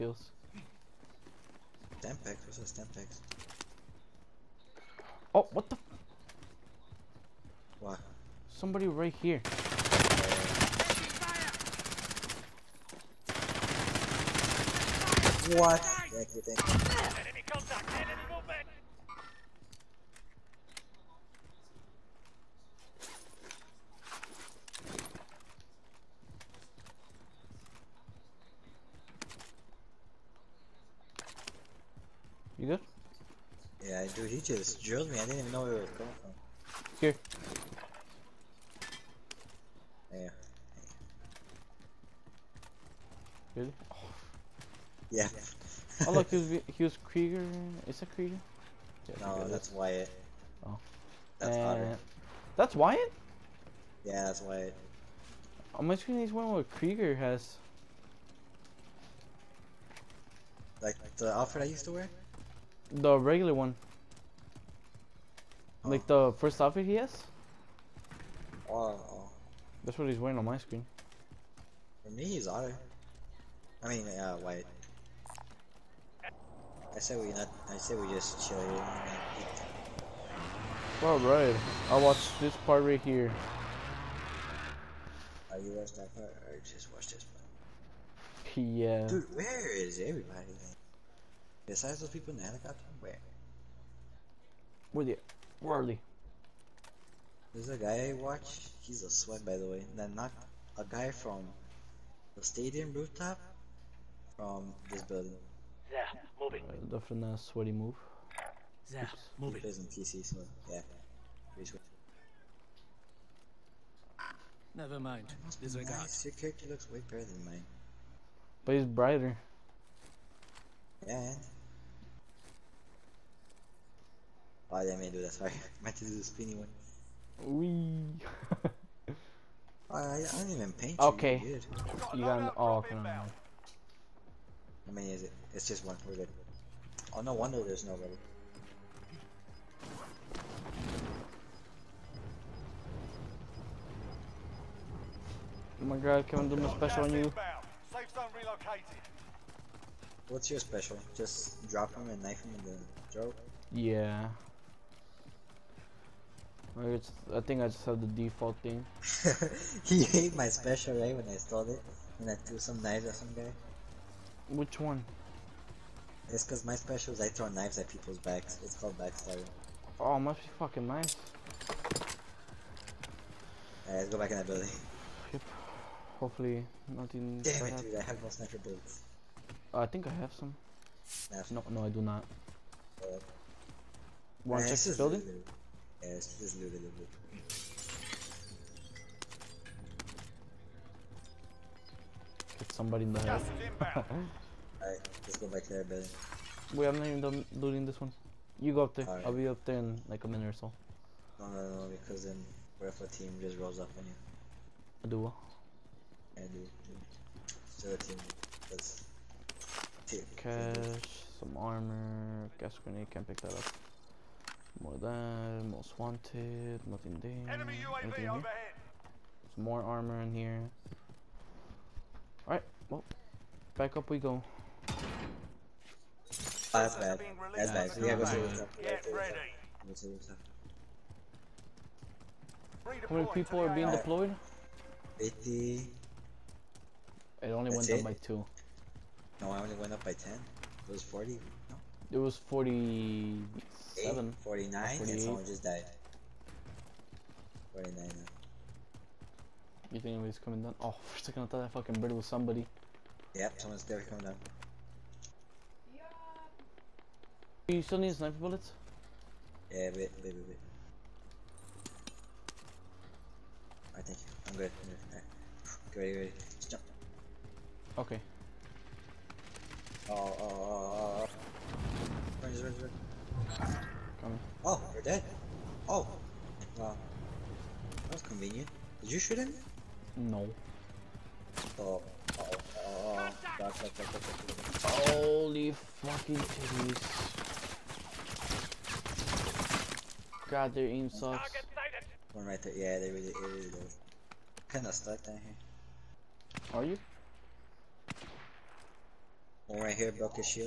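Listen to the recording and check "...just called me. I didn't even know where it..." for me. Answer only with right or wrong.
wrong.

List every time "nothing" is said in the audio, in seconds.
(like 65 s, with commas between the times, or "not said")
176 s, 216 s.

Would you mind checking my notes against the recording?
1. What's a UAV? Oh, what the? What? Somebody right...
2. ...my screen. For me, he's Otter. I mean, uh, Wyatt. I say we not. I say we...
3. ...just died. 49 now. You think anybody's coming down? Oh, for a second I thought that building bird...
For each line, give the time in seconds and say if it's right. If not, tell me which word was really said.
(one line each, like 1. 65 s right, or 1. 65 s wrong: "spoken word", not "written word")
1. 2 s wrong: "Semtex", not "UAV"
2. 70 s right
3. 245 s wrong: "fucking", not "building".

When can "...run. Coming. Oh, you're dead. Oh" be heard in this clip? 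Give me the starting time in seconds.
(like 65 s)
272 s.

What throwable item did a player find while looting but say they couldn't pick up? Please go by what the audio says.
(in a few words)
gas grenade.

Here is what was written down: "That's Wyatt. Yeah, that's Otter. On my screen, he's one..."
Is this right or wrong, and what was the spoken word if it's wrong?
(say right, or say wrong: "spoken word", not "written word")
wrong: "Wyatt", not "Otter".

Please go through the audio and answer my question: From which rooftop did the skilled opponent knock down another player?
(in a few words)
stadium rooftop.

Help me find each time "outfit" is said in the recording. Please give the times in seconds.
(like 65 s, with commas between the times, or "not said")
61 s, 66 s.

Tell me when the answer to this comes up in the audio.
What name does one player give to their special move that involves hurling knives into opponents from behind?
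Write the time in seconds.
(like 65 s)
168 s.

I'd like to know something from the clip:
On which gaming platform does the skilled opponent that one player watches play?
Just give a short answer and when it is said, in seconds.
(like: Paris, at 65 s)
PC, at 109 s.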